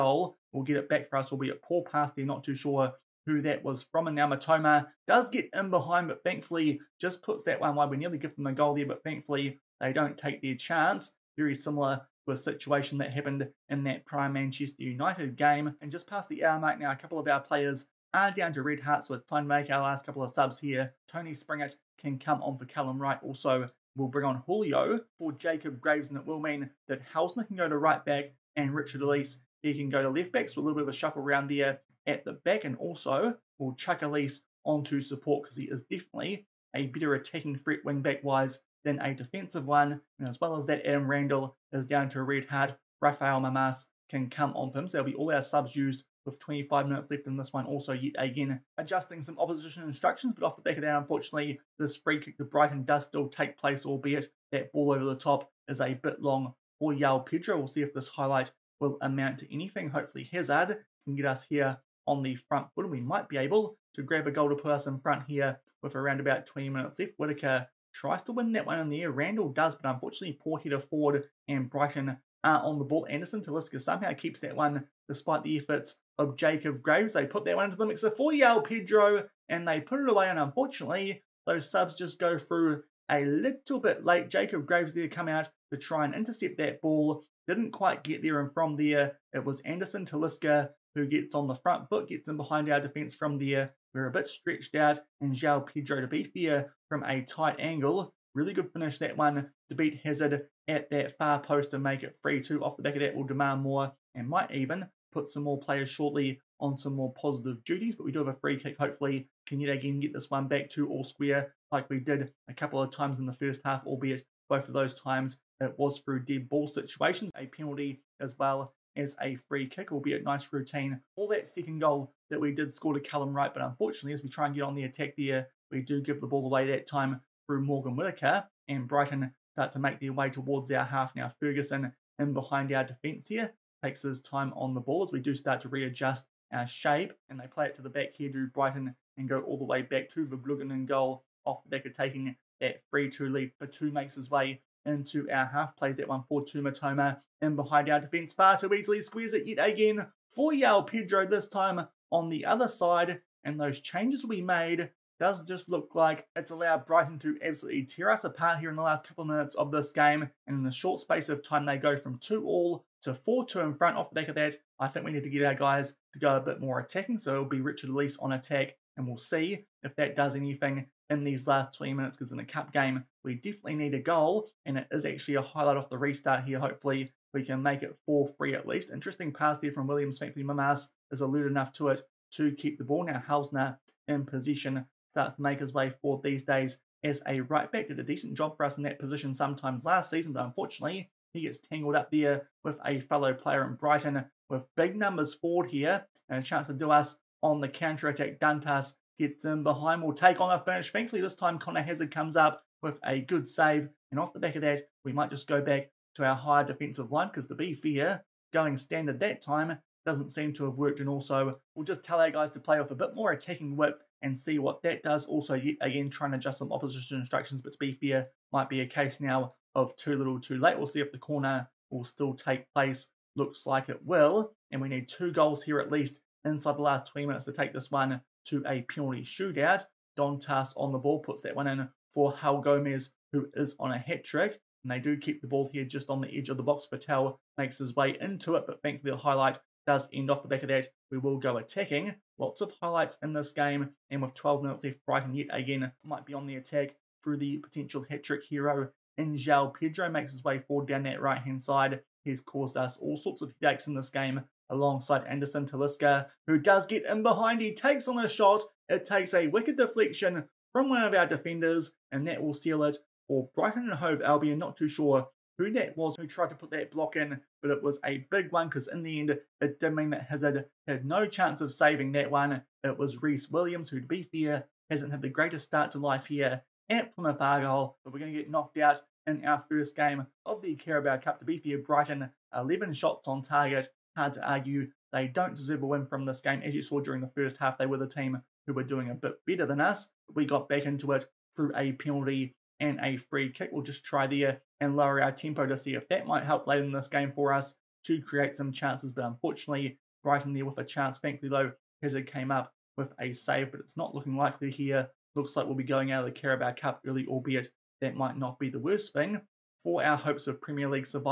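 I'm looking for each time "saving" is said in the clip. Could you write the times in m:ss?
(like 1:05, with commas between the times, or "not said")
4:31.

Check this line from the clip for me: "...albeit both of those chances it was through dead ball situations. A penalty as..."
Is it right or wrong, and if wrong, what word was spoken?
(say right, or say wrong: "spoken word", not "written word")
wrong: "times", not "chances".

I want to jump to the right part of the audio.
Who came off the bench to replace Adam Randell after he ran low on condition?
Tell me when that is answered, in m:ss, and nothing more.
0:42.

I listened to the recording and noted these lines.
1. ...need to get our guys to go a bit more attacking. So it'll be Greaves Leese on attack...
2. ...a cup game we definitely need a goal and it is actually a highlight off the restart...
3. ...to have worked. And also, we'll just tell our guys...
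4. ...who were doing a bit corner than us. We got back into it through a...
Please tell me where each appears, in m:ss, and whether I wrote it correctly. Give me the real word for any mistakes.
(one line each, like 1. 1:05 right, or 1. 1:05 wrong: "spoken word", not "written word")
1. 2:45 wrong: "Richard", not "Greaves"
2. 2:52 right
3. 3:30 right
4. 4:48 wrong: "better", not "corner".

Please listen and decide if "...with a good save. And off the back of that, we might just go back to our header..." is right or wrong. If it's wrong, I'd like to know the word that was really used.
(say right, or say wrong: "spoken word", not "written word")
wrong: "higher", not "header".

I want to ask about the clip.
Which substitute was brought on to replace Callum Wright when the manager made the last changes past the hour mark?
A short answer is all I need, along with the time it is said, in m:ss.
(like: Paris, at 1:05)
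Tony Springett, at 0:21.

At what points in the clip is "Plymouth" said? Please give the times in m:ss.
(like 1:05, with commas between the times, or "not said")
4:37.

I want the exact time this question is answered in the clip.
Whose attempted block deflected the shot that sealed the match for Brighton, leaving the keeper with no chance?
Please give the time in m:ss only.
4:33.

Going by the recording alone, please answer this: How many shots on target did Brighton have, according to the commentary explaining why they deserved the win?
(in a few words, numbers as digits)
11.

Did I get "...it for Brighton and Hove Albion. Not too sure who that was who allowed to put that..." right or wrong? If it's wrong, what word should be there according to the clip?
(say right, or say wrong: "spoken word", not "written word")
wrong: "tried", not "allowed".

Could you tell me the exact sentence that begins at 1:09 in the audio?
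Randall does, but unfortunately, poor header Ford and Brighton are on the ball.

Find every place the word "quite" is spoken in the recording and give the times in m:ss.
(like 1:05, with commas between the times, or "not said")
1:27.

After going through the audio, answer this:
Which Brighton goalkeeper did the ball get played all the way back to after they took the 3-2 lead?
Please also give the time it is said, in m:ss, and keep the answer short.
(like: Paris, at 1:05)
Verbruggen, at 2:20.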